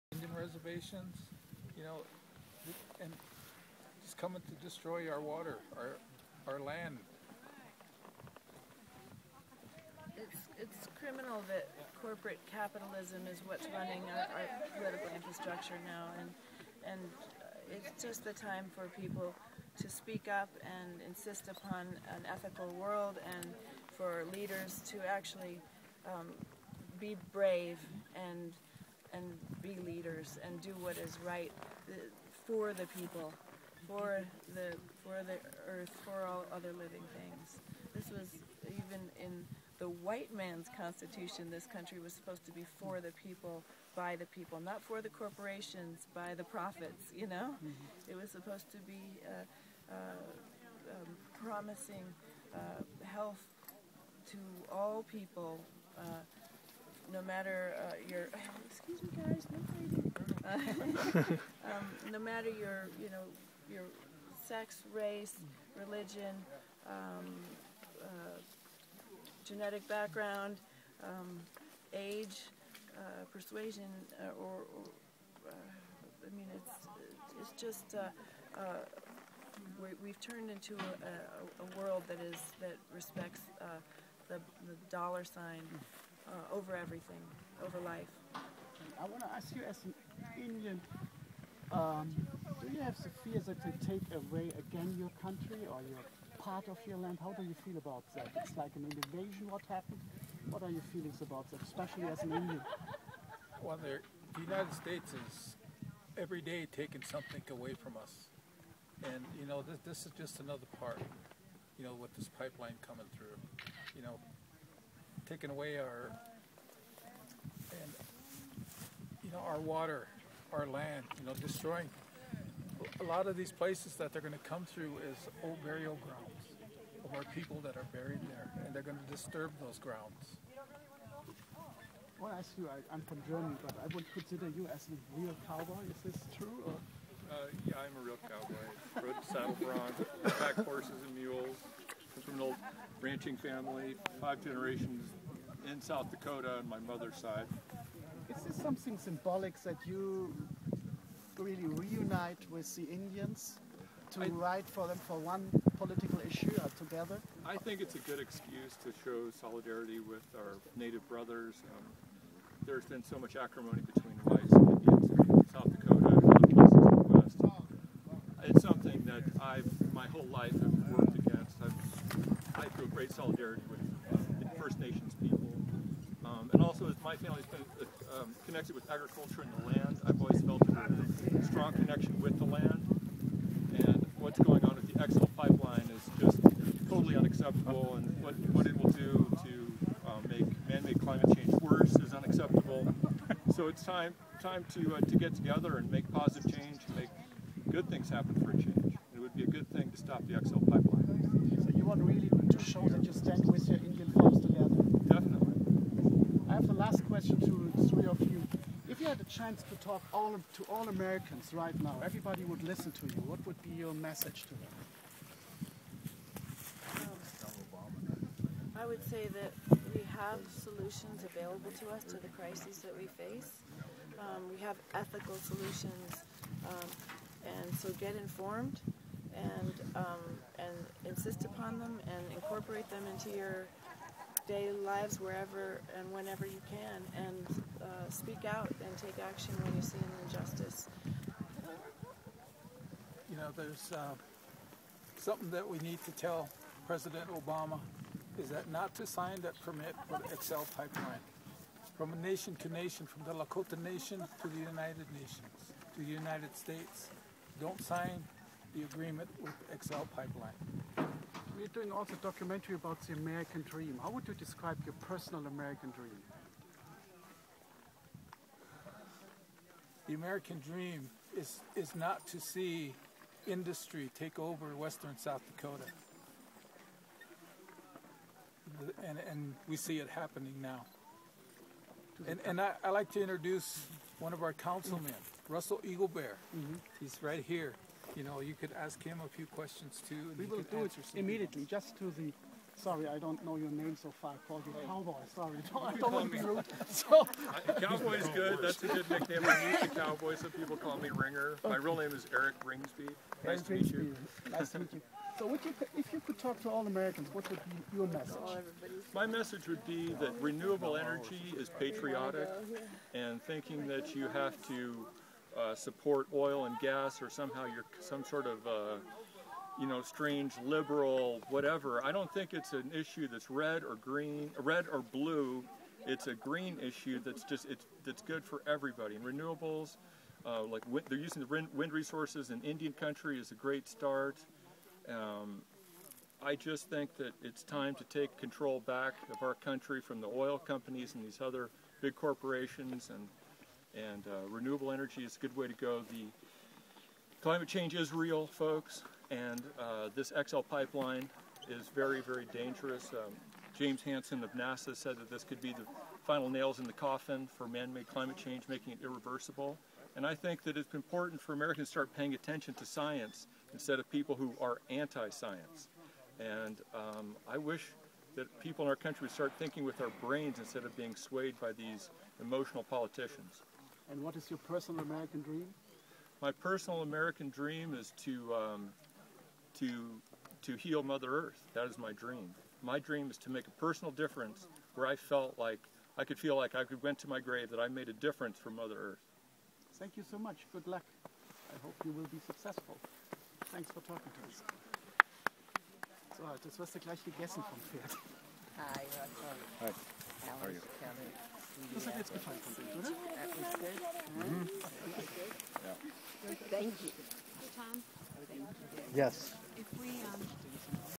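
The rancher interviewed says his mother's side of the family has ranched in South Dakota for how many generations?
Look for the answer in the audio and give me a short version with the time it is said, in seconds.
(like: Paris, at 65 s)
5, at 144 s.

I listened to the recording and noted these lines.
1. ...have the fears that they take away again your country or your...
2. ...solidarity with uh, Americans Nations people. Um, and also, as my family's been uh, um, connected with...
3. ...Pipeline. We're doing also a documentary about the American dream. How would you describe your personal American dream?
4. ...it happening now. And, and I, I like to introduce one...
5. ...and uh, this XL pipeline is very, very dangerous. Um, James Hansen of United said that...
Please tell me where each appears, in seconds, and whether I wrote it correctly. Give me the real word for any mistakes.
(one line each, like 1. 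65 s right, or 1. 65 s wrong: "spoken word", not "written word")
1. 92 s right
2. 173 s wrong: "First", not "Americans"
3. 260 s right
4. 279 s right
5. 349 s wrong: "NASA", not "United".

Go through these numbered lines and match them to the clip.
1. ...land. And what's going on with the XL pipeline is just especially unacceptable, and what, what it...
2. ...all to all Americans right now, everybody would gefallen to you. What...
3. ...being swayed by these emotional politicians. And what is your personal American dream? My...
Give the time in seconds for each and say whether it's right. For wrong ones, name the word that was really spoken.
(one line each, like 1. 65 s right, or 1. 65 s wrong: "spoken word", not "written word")
1. 182 s wrong: "totally", not "especially"
2. 210 s wrong: "listen", not "gefallen"
3. 370 s right.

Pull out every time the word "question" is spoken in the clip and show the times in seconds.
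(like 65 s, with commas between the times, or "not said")
207 s, 289 s.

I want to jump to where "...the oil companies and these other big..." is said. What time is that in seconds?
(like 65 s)
340 s.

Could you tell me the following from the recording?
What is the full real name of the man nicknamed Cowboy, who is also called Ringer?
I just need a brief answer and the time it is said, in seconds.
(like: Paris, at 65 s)
Eric Ringsby, at 302 s.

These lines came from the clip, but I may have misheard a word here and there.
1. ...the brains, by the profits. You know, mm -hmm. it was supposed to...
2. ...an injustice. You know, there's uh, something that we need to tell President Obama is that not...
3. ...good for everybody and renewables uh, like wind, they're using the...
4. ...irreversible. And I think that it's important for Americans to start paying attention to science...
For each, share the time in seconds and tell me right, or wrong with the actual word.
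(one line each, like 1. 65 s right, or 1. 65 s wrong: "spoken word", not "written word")
1. 45 s wrong: "corporations", not "brains"
2. 239 s right
3. 328 s right
4. 359 s right.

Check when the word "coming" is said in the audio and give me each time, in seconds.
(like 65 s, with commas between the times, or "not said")
4 s, 112 s.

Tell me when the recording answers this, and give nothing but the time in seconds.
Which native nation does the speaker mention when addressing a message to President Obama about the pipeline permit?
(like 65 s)
253 s.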